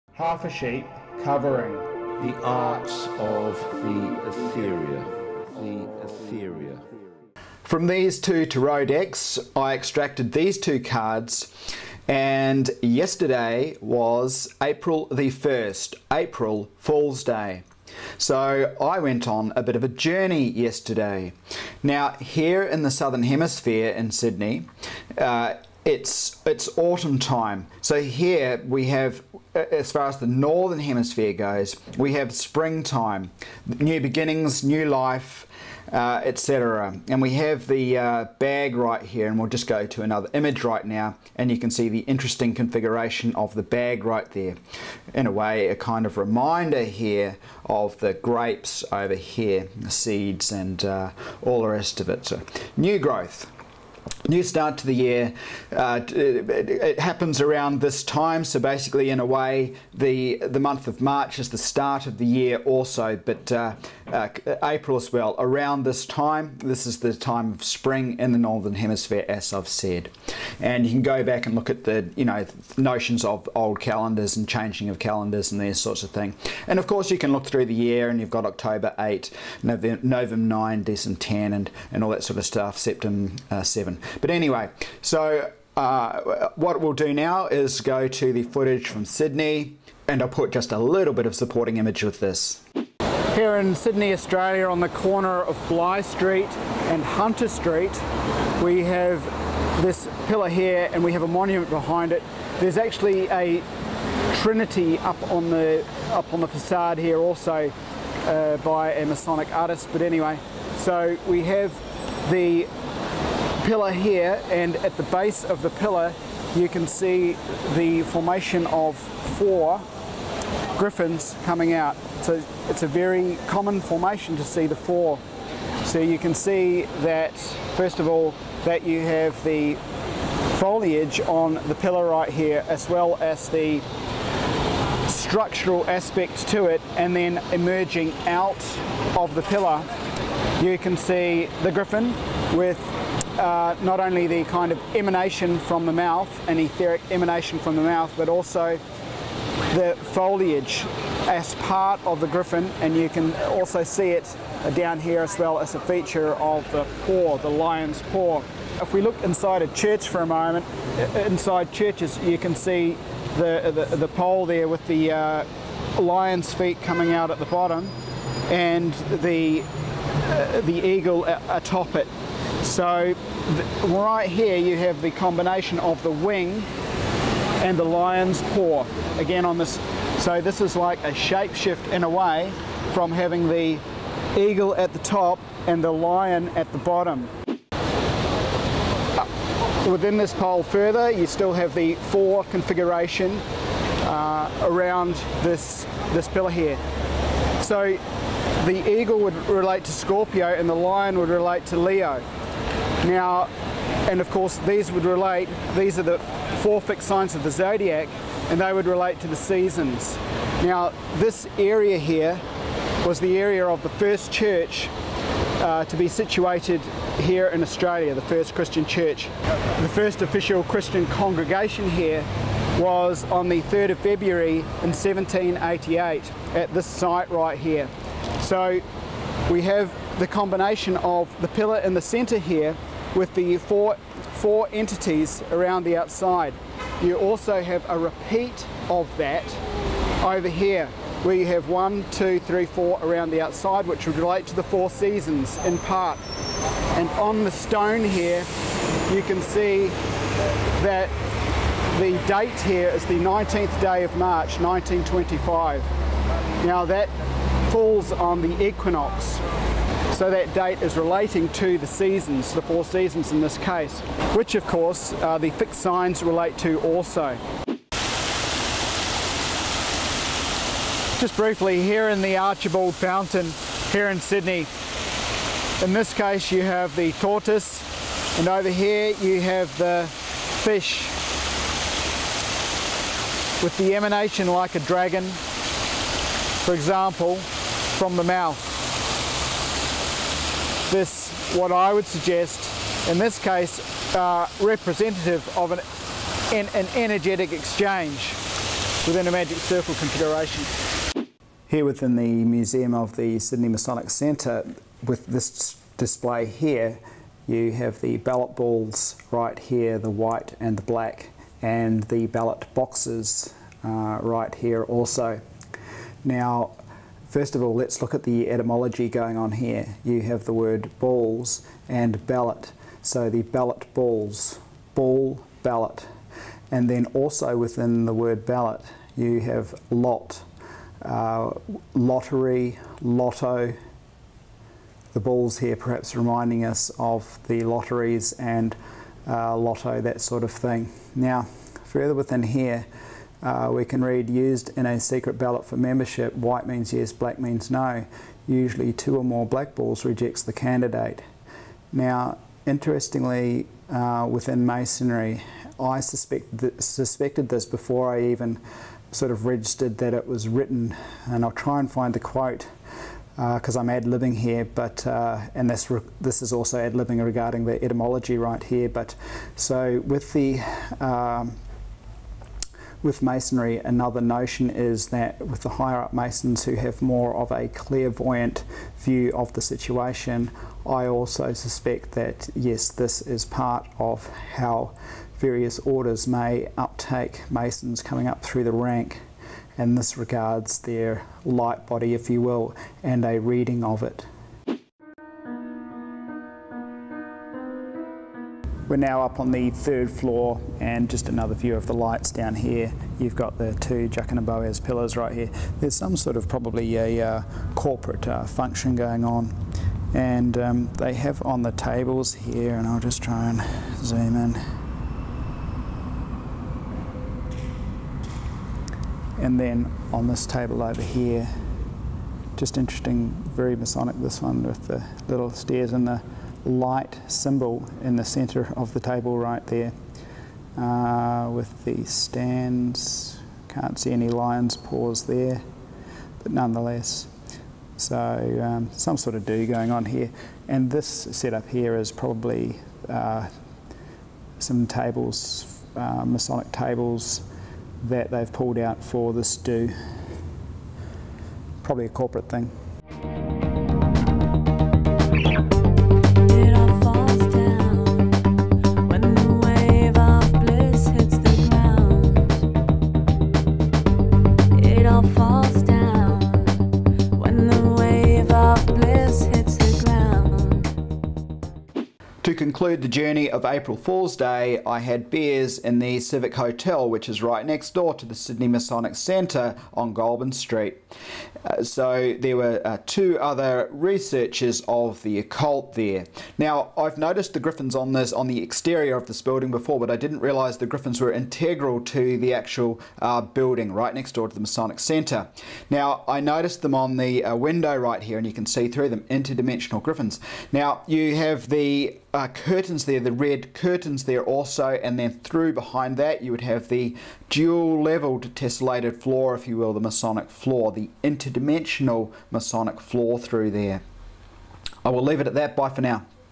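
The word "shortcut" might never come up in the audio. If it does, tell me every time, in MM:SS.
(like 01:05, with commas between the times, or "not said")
not said.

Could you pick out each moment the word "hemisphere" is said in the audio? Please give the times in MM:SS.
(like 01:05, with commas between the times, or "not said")
00:23, 00:30, 01:08.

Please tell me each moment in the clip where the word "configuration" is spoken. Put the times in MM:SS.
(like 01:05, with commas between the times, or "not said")
00:42, 03:12, 04:59.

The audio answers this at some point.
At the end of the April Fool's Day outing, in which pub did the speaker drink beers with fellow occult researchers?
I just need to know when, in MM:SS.
07:56.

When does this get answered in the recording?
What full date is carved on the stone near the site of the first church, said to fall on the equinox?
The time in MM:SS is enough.
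04:13.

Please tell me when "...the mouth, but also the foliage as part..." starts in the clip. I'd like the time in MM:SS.
02:27.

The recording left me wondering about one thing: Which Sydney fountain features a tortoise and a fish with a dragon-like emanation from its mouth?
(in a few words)
Archibald Fountain.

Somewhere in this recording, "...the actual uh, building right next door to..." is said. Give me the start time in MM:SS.
08:12.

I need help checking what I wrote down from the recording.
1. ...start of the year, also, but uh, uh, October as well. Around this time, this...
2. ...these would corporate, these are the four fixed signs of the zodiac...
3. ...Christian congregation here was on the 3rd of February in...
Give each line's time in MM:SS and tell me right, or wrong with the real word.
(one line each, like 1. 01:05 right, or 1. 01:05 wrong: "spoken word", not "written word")
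1. 01:01 wrong: "April", not "October"
2. 03:24 wrong: "relate", not "corporate"
3. 03:40 right.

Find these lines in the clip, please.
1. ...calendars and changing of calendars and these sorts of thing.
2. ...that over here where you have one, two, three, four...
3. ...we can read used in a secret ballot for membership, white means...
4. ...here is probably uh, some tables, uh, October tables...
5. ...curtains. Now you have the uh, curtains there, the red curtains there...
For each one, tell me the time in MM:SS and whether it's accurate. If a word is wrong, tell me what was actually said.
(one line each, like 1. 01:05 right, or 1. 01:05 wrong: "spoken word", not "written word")
1. 01:13 right
2. 03:59 right
3. 05:43 right
4. 07:21 wrong: "Masonic", not "October"
5. 08:20 wrong: "griffins", not "curtains".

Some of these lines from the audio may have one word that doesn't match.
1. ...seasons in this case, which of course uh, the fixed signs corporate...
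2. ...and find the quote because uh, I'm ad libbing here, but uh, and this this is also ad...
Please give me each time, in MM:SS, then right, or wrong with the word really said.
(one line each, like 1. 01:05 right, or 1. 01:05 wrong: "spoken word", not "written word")
1. 04:22 wrong: "relate", not "corporate"
2. 06:01 right.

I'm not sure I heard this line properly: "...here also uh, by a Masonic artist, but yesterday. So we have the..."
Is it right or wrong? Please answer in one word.
wrong.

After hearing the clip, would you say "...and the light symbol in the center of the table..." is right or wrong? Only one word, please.
right.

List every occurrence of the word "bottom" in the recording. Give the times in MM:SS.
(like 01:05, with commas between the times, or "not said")
02:47, 03:06.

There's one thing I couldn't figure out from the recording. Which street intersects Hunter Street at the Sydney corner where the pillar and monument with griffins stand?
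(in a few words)
Bligh Street.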